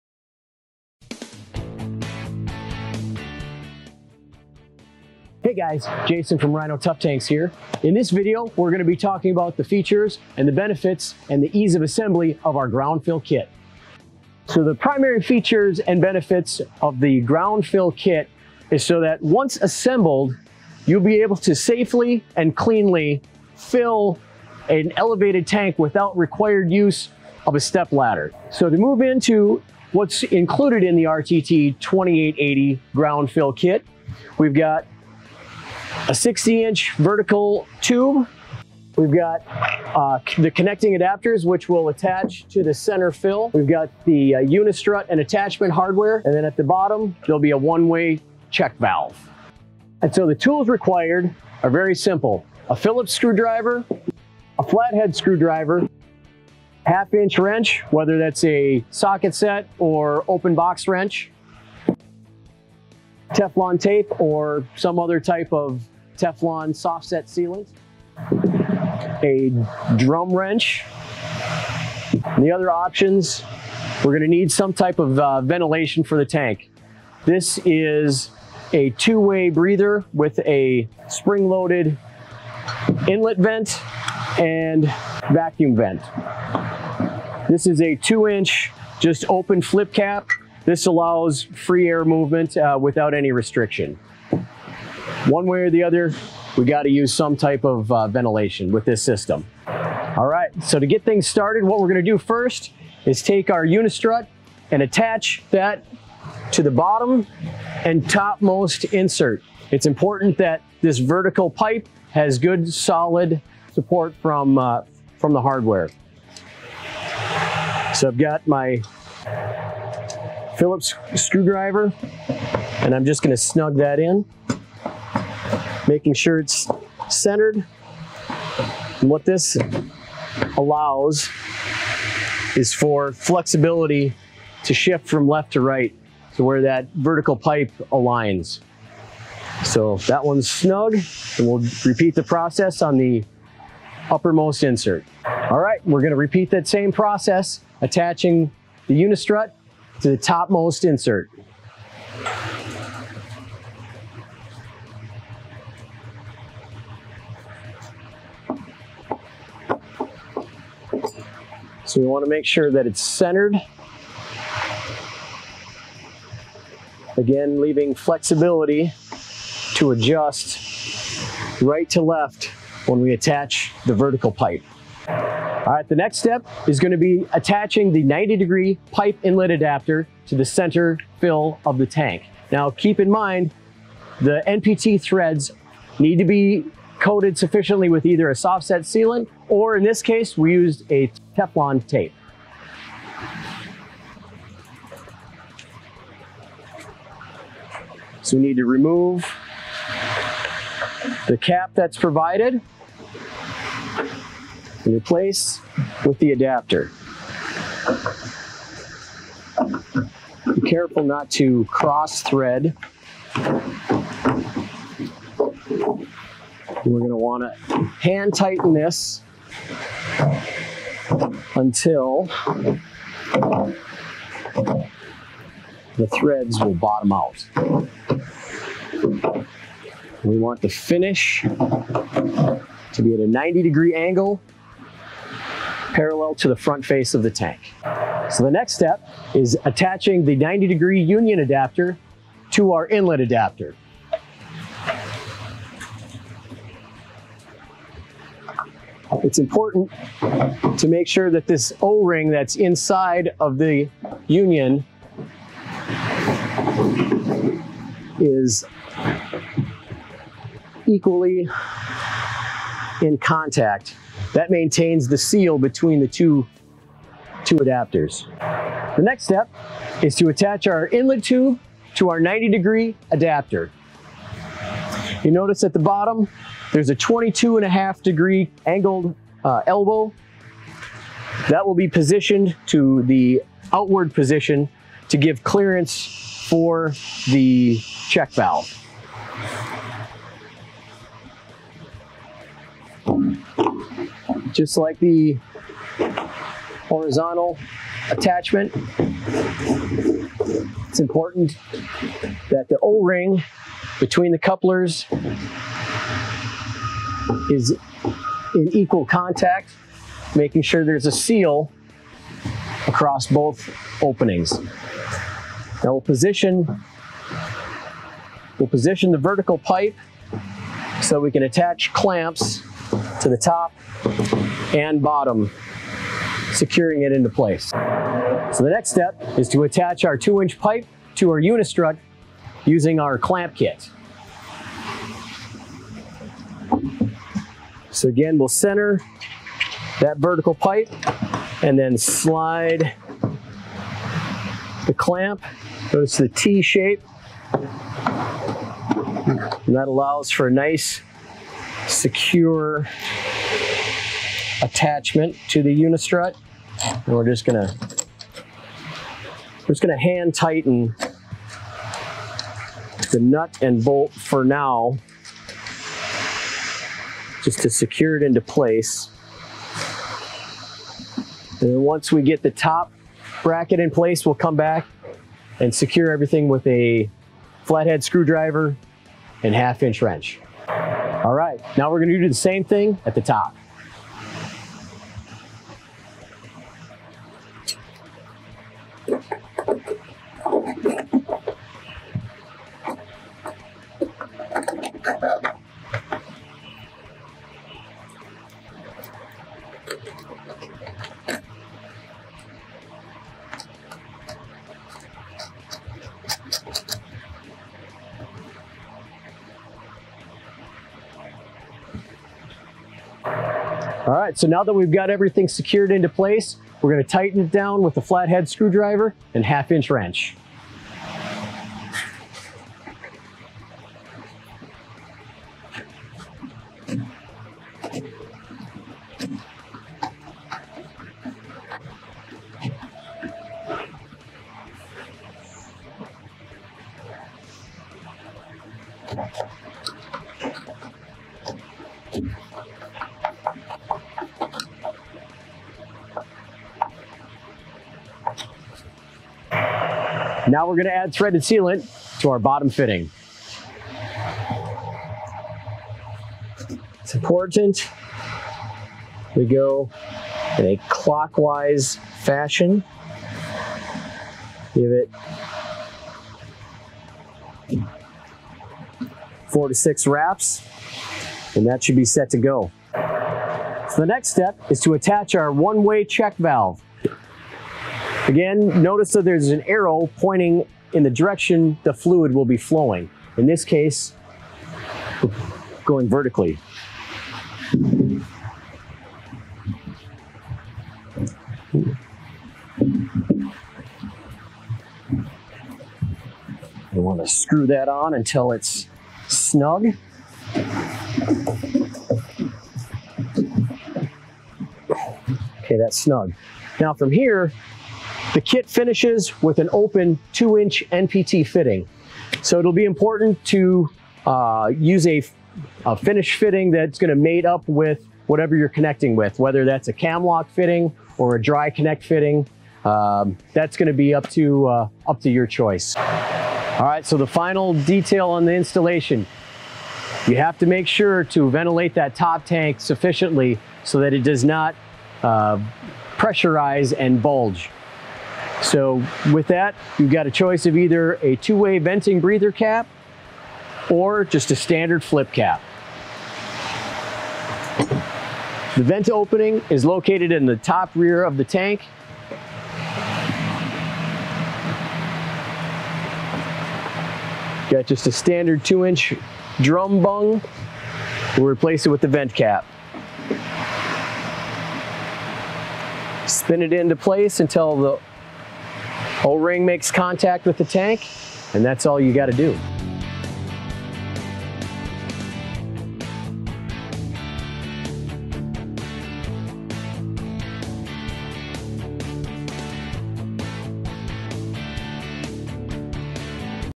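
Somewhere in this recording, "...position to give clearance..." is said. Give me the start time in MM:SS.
04:44.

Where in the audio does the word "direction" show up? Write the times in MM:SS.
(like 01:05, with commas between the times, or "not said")
08:01.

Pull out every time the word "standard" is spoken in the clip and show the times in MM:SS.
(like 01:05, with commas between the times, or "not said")
09:04, 09:18.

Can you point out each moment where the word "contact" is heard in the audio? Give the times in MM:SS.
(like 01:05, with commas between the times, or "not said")
04:23, 05:09, 09:29.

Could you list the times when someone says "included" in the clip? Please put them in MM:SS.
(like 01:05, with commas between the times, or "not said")
00:30.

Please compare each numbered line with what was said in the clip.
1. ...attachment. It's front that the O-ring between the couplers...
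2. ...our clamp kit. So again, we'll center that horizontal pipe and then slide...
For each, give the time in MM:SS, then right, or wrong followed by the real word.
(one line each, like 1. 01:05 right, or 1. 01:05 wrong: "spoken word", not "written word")
1. 04:58 wrong: "important", not "front"
2. 05:33 wrong: "vertical", not "horizontal".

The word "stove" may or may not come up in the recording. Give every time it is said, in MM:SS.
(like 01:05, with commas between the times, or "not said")
not said.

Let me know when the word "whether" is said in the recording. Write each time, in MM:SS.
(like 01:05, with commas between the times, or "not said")
00:57, 08:39.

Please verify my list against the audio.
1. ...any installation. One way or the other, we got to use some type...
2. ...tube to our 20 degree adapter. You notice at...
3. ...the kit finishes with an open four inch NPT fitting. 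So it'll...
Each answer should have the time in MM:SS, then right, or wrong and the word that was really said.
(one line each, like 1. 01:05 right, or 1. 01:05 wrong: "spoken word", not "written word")
1. 01:33 wrong: "restriction", not "installation"
2. 04:31 wrong: "90", not "20"
3. 08:28 wrong: "two", not "four".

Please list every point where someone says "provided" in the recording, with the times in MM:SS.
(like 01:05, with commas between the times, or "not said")
03:21.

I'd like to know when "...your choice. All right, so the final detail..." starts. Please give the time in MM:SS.
08:45.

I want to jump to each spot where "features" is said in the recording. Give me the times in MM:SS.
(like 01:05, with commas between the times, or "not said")
00:09, 00:15.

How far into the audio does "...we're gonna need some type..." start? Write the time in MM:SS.
01:14.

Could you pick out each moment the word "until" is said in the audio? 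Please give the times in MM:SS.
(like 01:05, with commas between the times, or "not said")
03:41, 08:18, 09:27.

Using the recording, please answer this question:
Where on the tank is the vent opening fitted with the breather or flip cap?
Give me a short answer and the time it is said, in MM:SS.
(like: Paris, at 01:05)
top rear, at 09:10.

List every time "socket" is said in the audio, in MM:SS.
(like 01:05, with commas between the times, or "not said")
00:58.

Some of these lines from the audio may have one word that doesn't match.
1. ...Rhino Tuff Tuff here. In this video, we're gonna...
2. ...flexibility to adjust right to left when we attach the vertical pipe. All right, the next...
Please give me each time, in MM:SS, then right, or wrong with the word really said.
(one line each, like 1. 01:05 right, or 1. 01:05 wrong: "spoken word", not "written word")
1. 00:06 wrong: "Tanks", not "Tuff"
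2. 02:47 right.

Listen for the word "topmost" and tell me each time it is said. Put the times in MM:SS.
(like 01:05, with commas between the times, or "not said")
01:48, 02:30.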